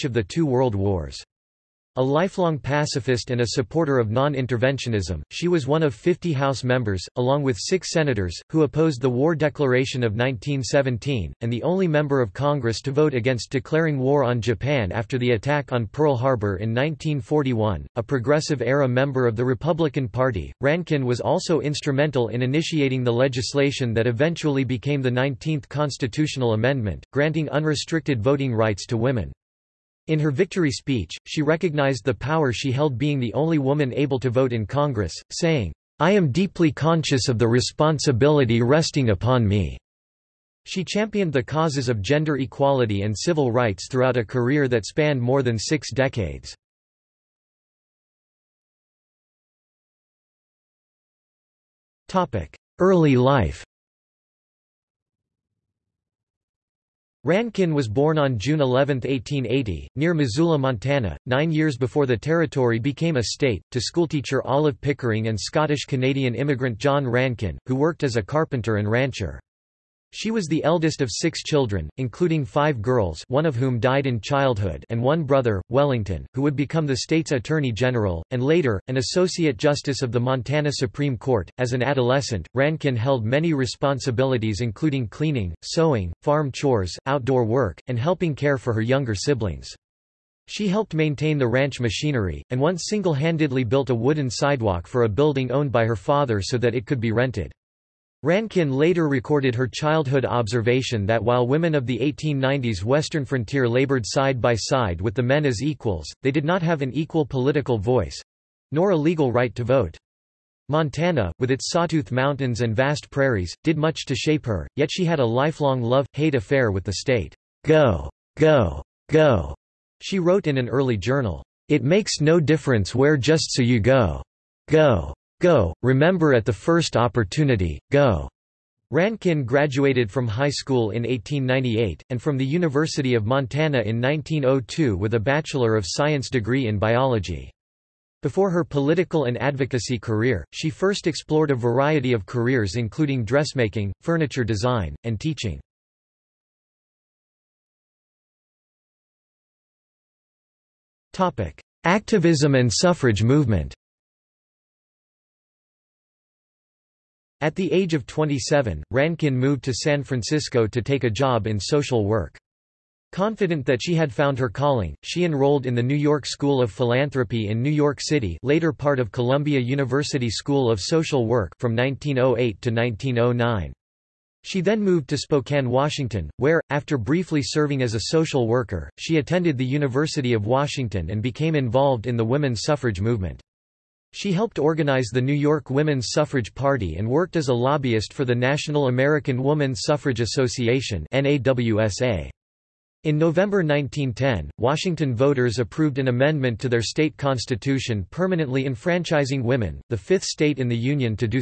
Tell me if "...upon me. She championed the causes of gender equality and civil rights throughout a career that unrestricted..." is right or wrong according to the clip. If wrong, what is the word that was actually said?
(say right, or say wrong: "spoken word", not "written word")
wrong: "spanned", not "unrestricted".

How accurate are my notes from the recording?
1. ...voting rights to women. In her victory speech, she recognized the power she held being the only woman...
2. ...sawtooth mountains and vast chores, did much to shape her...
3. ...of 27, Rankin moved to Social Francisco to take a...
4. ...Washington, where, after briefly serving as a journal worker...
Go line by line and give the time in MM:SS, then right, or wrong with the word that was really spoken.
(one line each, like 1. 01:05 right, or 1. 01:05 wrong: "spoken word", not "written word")
1. 00:28 right
2. 01:51 wrong: "prairies", not "chores"
3. 02:37 wrong: "San", not "Social"
4. 02:55 wrong: "social", not "journal".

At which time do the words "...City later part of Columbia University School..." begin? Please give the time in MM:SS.
02:48.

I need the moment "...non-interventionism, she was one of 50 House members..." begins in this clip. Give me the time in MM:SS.
00:04.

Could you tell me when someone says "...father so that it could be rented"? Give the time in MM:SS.
01:35.